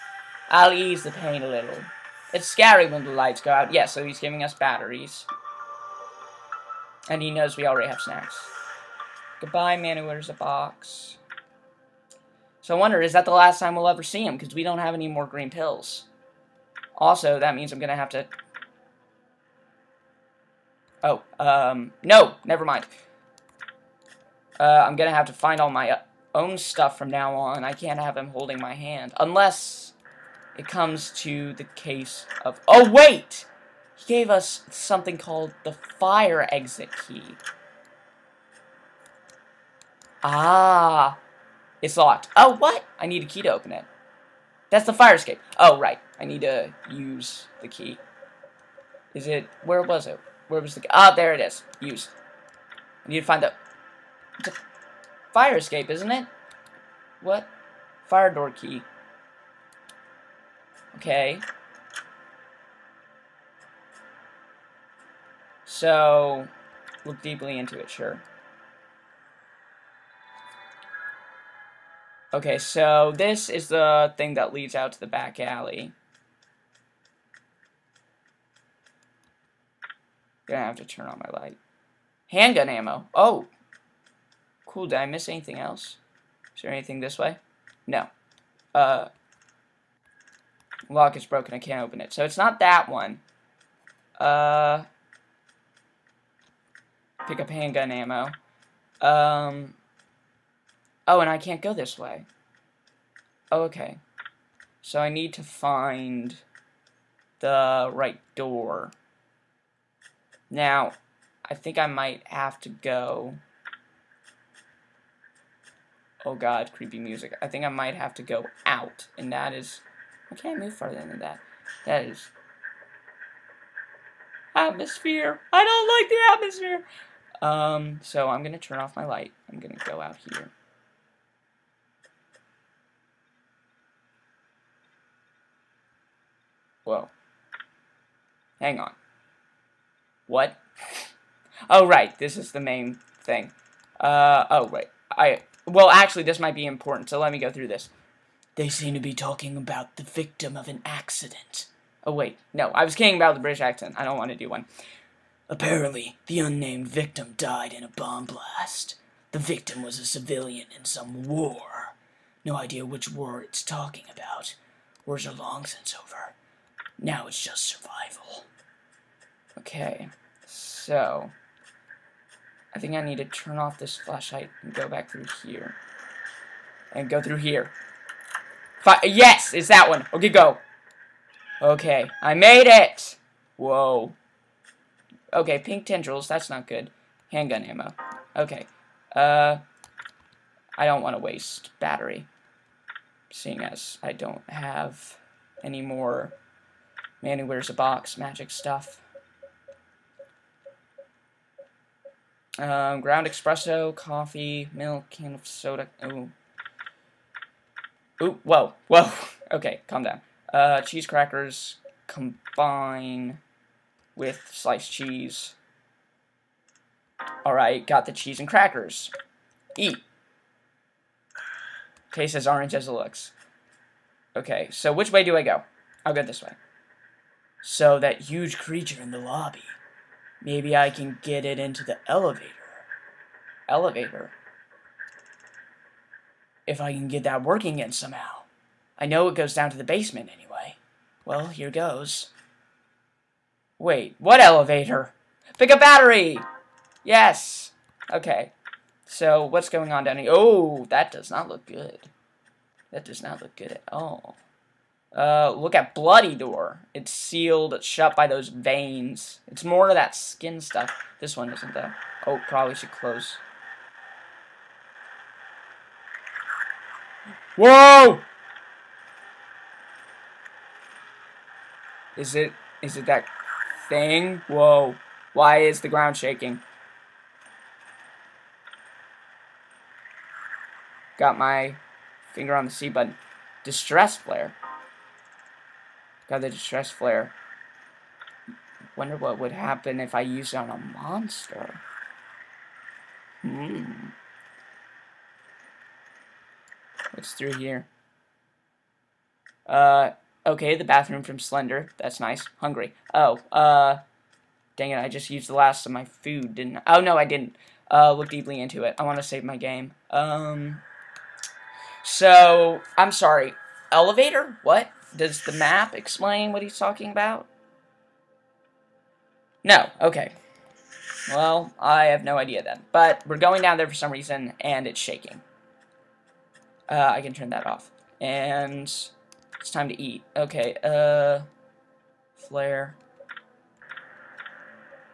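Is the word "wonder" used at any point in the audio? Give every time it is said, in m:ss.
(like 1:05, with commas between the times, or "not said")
0:12, 4:48.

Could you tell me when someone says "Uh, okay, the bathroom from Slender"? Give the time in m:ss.
4:59.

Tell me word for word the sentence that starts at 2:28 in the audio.
They seem to be talking about the victim of an accident.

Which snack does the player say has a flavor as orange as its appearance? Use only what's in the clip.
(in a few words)
cheese crackers.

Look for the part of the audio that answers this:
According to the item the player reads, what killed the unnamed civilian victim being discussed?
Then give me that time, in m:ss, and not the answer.
2:37.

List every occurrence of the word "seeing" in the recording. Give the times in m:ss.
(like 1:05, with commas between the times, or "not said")
3:13.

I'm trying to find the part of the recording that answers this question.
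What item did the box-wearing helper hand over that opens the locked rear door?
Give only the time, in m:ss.
0:35.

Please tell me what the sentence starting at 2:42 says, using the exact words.
No idea which war it's talking about.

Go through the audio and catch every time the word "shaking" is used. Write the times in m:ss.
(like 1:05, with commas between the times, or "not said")
4:36, 5:25.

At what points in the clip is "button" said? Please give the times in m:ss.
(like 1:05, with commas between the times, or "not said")
4:42.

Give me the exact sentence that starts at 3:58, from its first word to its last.
I know it goes down to the basement anyway.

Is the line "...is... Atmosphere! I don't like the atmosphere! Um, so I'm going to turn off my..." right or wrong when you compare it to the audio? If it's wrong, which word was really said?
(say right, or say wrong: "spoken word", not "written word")
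right.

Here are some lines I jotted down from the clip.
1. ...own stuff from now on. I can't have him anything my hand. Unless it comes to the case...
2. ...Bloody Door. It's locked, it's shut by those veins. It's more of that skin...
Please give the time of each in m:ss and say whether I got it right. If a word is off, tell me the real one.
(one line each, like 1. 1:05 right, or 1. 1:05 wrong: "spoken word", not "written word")
1. 0:26 wrong: "holding", not "anything"
2. 4:15 wrong: "sealed", not "locked".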